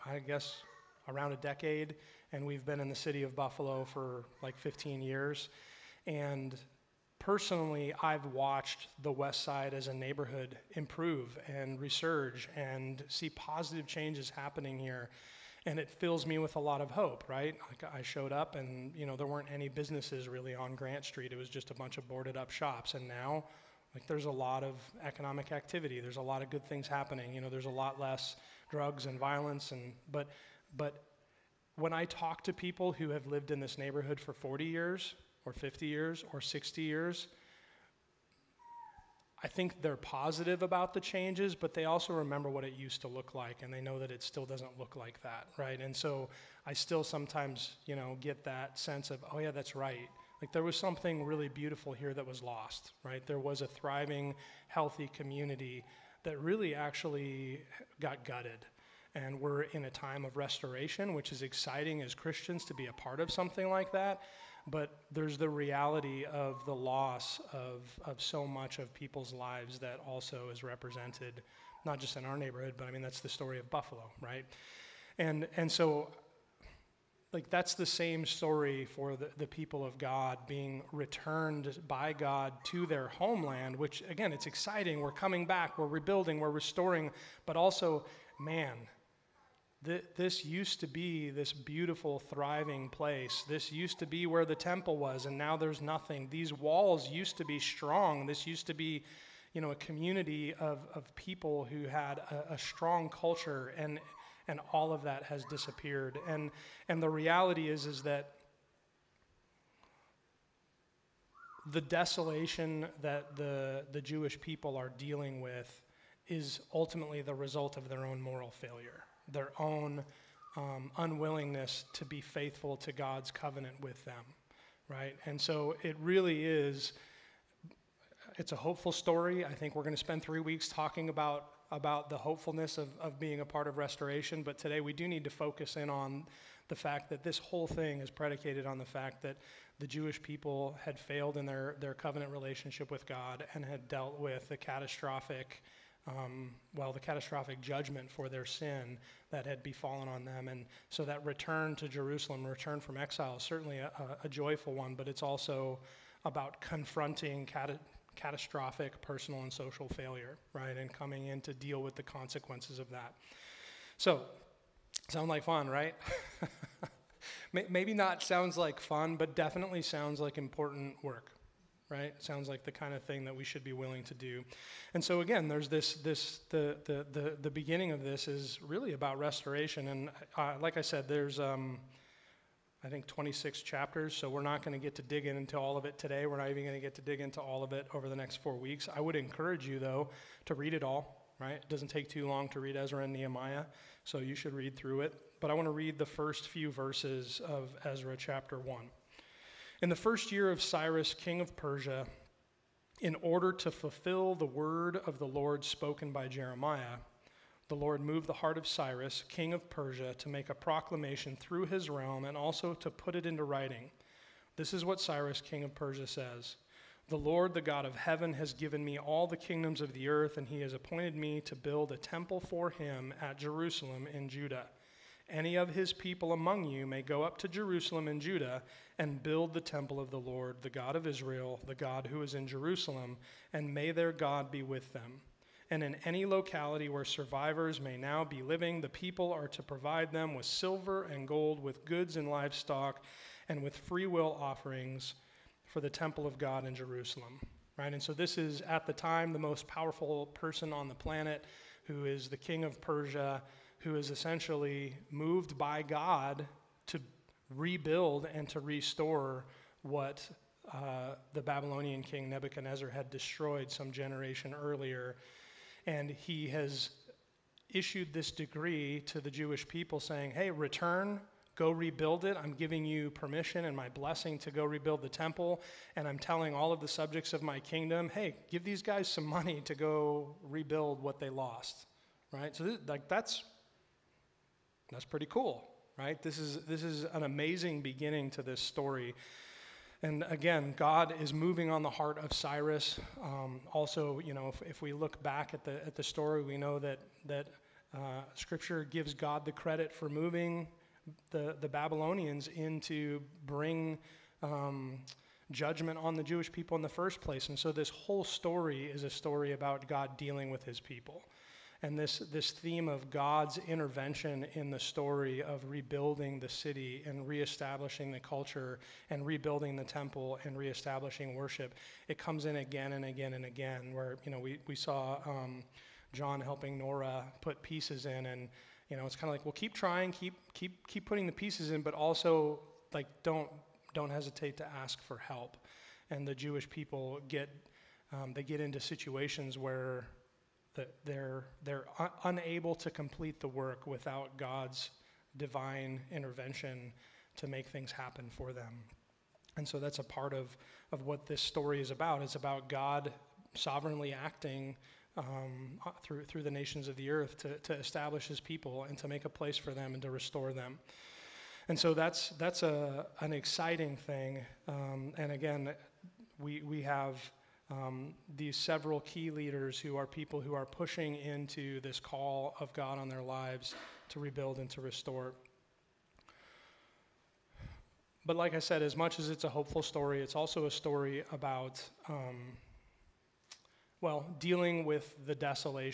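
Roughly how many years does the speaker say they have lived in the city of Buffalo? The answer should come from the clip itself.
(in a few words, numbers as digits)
15 years.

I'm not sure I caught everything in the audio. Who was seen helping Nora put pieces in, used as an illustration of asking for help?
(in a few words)
John.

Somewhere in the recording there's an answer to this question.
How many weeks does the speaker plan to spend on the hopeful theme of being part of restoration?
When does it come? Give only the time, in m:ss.
2:10.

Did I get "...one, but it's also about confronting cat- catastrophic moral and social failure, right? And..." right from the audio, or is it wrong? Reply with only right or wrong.
wrong.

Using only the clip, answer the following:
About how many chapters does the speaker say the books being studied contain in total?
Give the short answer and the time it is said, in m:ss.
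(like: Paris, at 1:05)
26, at 3:03.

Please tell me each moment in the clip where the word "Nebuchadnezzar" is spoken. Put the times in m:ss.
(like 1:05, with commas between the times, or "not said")
4:22.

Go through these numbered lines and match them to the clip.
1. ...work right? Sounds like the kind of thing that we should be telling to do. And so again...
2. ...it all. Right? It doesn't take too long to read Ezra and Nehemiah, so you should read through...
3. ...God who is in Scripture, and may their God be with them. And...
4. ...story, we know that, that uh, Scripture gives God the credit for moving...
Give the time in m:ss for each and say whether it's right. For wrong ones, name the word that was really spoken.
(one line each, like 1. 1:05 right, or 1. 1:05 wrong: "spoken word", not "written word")
1. 2:51 wrong: "willing", not "telling"
2. 3:10 right
3. 3:51 wrong: "Jerusalem", not "Scripture"
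4. 4:56 right.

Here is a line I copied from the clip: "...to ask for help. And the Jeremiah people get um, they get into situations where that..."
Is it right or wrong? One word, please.
wrong.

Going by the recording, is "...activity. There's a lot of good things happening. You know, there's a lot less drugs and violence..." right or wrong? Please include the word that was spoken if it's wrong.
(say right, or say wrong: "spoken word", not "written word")
right.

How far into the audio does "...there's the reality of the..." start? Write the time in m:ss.
1:05.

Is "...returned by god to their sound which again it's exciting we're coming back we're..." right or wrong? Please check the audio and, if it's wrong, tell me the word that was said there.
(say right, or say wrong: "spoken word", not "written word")
wrong: "homeland", not "sound".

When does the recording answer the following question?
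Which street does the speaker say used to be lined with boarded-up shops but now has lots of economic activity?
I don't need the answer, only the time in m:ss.
0:20.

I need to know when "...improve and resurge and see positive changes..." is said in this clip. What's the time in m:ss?
0:10.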